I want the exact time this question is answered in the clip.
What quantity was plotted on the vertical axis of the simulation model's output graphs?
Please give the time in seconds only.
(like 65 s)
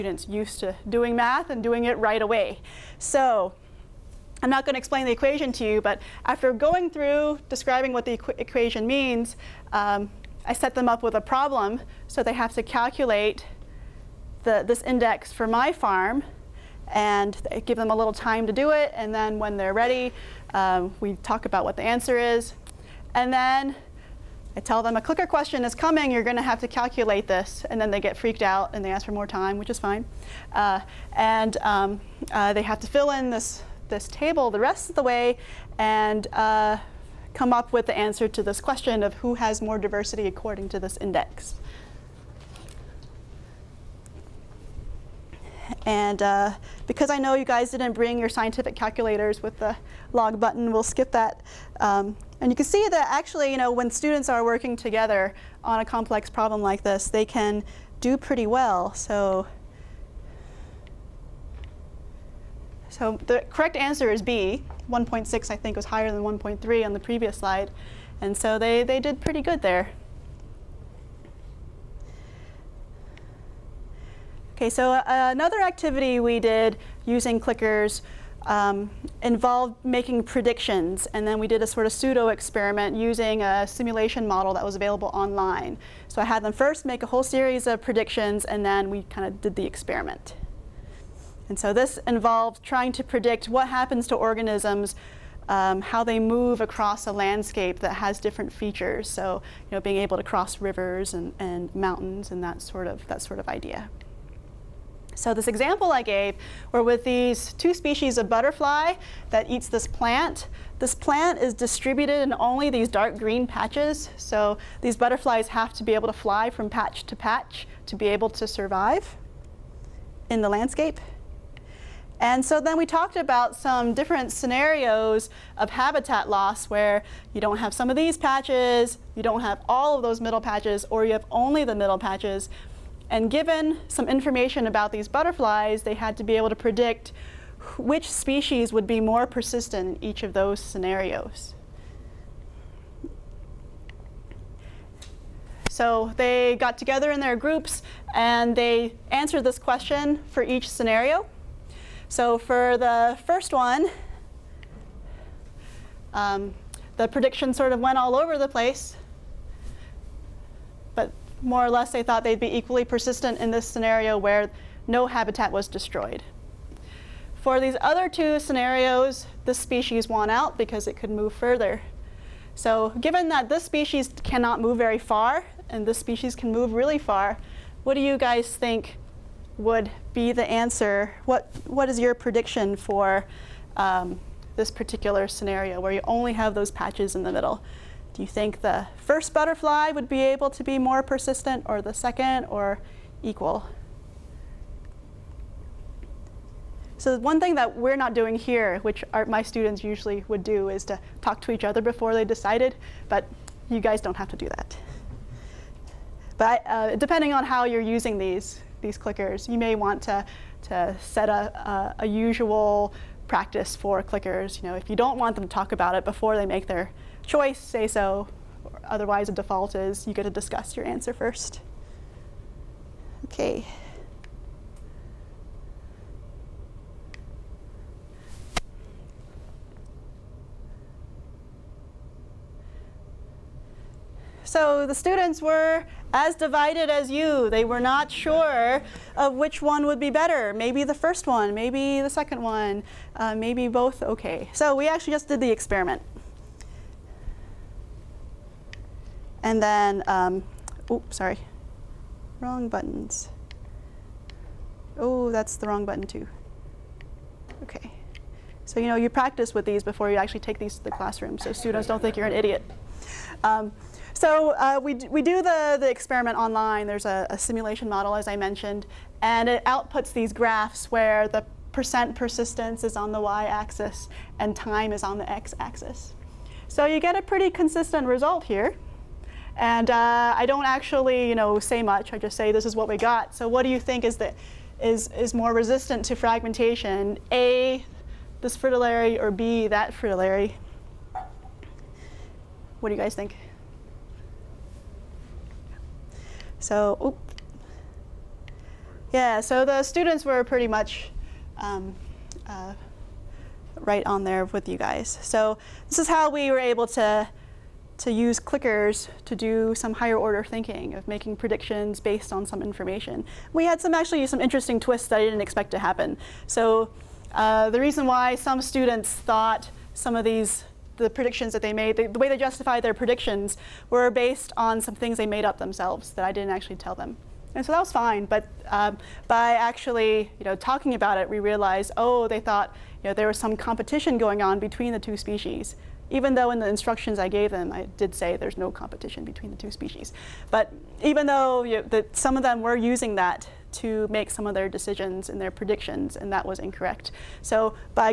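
271 s.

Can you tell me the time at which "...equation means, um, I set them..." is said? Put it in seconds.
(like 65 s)
8 s.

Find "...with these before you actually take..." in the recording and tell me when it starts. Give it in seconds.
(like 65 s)
259 s.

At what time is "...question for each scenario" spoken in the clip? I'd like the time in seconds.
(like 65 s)
149 s.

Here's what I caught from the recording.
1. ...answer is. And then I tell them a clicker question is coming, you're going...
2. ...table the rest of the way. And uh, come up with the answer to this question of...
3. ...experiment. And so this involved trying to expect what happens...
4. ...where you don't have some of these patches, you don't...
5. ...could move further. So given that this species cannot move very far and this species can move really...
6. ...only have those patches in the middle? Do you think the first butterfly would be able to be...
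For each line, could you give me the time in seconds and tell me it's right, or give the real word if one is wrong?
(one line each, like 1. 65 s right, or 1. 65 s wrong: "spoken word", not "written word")
1. 21 s right
2. 34 s right
3. 89 s wrong: "predict", not "expect"
4. 126 s right
5. 170 s right
6. 186 s right.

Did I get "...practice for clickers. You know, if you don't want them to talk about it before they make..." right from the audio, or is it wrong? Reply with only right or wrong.
right.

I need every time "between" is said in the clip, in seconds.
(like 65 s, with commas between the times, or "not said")
334 s, 339 s.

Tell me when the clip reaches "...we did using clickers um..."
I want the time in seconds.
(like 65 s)
76 s.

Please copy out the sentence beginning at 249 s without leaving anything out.
And then, um, oh, sorry, wrong buttons.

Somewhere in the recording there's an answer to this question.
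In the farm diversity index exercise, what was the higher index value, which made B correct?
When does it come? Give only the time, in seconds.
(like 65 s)
64 s.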